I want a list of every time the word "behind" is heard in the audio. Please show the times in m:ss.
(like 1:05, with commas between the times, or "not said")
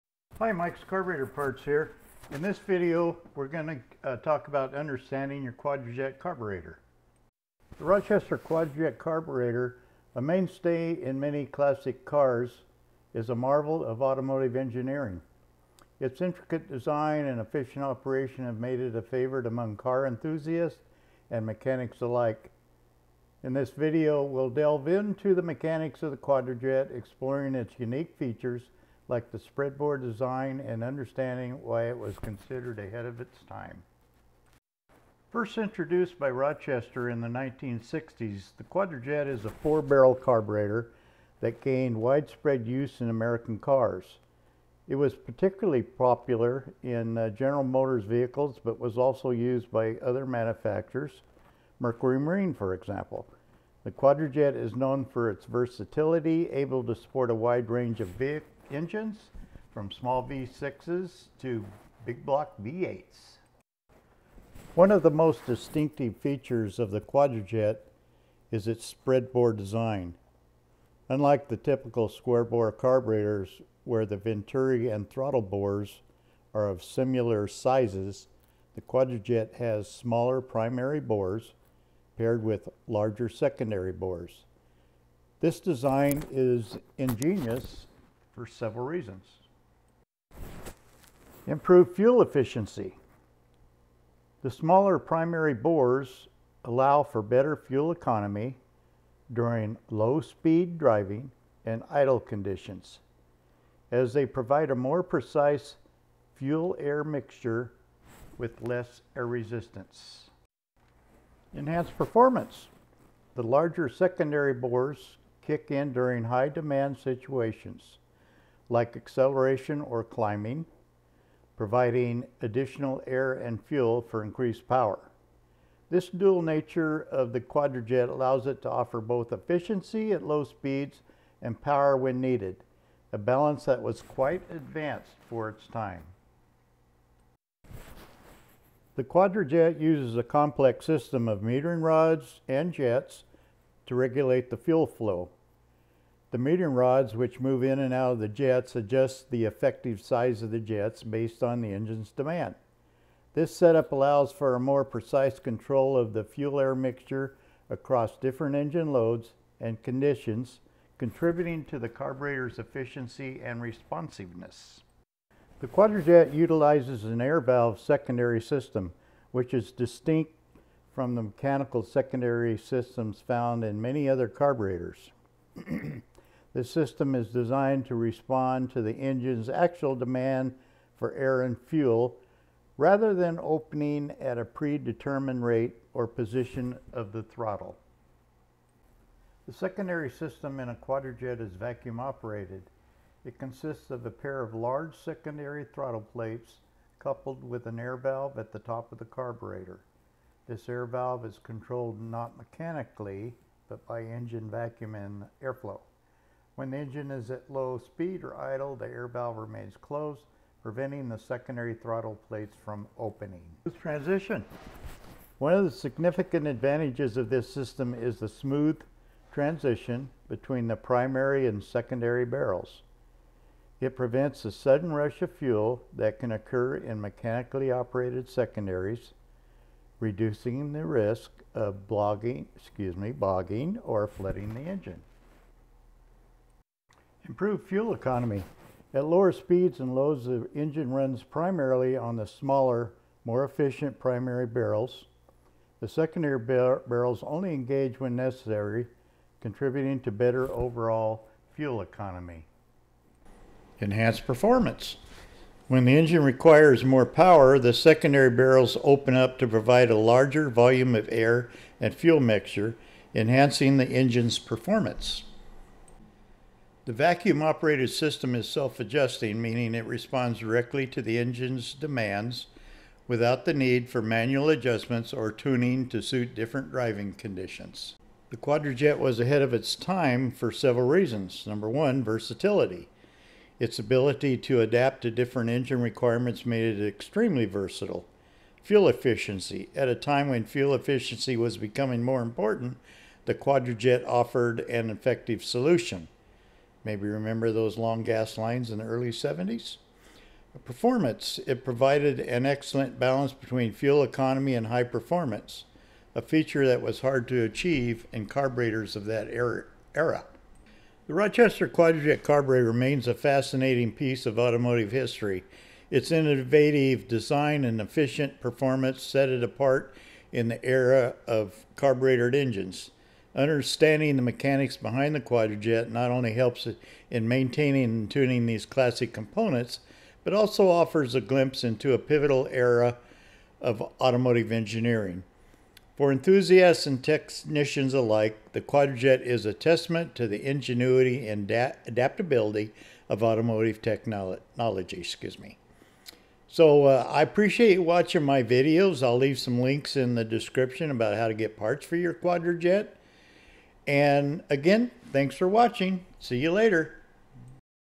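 5:24.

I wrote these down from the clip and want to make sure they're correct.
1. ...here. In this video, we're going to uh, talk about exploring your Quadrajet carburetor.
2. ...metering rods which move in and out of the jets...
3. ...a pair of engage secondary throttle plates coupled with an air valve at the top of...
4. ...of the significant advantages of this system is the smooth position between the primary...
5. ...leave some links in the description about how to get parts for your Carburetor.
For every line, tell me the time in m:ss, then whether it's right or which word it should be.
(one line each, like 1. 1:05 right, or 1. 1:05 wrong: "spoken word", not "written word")
1. 0:01 wrong: "understanding", not "exploring"
2. 2:26 right
3. 3:14 wrong: "large", not "engage"
4. 3:35 wrong: "transition", not "position"
5. 5:49 wrong: "Quadrajet", not "Carburetor".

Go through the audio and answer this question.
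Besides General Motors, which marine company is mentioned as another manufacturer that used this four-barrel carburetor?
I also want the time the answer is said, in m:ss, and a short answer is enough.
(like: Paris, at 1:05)
Mercury Marine, at 0:51.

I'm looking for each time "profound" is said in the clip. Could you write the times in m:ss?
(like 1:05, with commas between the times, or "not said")
not said.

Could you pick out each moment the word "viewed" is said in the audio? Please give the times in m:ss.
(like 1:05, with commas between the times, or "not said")
not said.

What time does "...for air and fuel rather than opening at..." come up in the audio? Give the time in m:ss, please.
3:00.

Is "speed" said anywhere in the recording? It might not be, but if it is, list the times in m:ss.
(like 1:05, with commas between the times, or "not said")
1:39, 2:10, 3:27, 3:59.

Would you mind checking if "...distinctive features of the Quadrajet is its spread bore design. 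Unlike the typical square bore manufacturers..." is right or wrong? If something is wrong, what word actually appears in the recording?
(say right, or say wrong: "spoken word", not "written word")
wrong: "carburetors", not "manufacturers".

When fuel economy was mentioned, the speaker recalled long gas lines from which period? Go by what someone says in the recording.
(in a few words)
the early 70s.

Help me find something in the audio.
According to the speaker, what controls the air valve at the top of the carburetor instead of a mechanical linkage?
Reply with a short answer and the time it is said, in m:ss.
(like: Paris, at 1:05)
engine vacuum and airflow, at 3:24.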